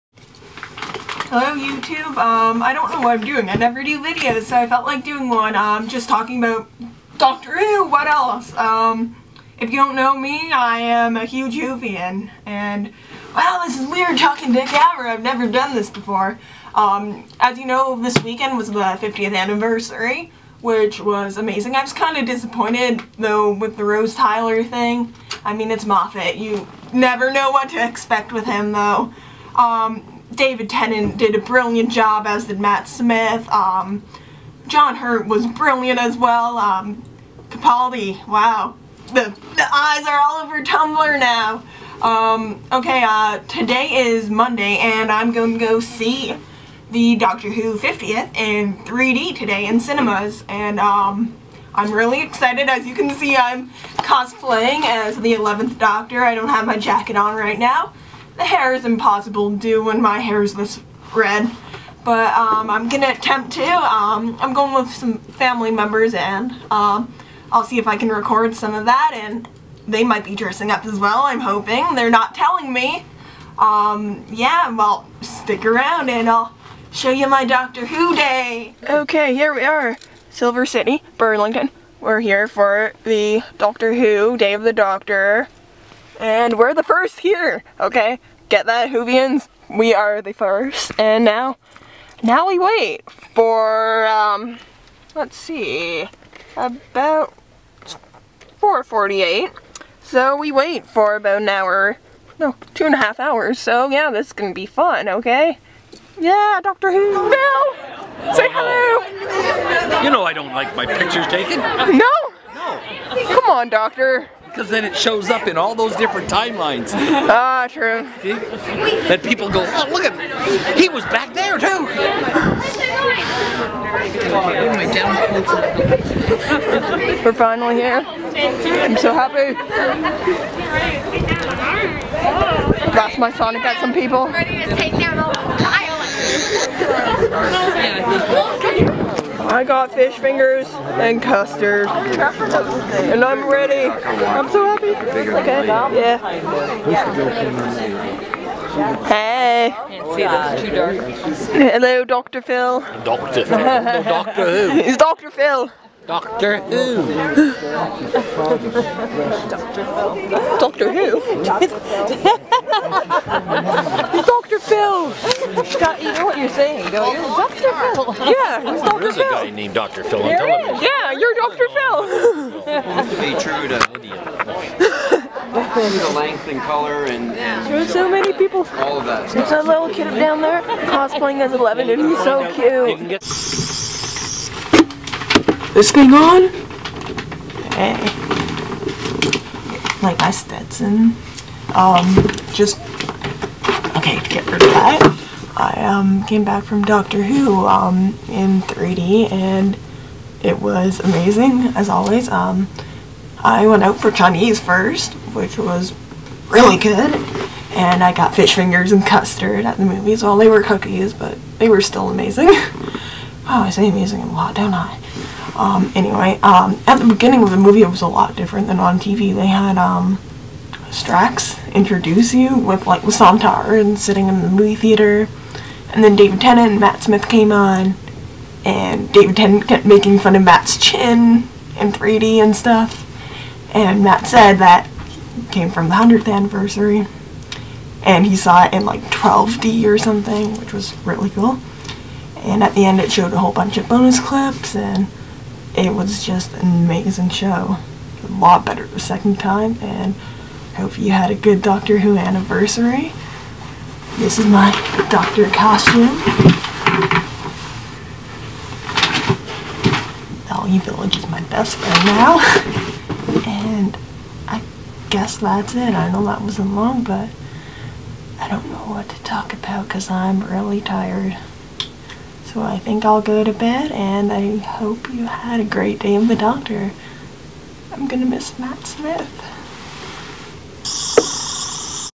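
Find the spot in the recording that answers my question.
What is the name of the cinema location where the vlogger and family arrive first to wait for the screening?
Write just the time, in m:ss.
1:20.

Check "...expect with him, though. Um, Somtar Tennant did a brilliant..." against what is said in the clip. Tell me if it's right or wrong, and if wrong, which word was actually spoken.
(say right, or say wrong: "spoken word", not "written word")
wrong: "David", not "Somtar".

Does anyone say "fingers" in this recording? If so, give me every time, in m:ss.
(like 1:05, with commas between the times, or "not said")
2:20, 3:28.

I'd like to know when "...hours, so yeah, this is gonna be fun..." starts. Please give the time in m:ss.
1:43.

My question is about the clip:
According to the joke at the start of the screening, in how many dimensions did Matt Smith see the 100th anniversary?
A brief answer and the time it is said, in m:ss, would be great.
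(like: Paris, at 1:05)
12D, at 3:59.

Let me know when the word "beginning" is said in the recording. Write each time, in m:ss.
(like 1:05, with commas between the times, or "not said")
3:37.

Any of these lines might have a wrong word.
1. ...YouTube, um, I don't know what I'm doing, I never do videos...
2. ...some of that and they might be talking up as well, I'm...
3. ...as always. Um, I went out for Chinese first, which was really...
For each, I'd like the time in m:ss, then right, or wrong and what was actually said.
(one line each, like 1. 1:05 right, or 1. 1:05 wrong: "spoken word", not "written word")
1. 0:01 right
2. 1:08 wrong: "dressing", not "talking"
3. 3:21 right.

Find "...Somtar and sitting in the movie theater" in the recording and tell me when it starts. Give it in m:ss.
3:43.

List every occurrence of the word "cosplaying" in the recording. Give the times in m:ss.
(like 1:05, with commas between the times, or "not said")
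0:53, 3:00.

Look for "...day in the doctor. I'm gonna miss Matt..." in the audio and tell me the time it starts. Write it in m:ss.
4:35.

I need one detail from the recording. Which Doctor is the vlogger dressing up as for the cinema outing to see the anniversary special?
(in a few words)
11th Doctor.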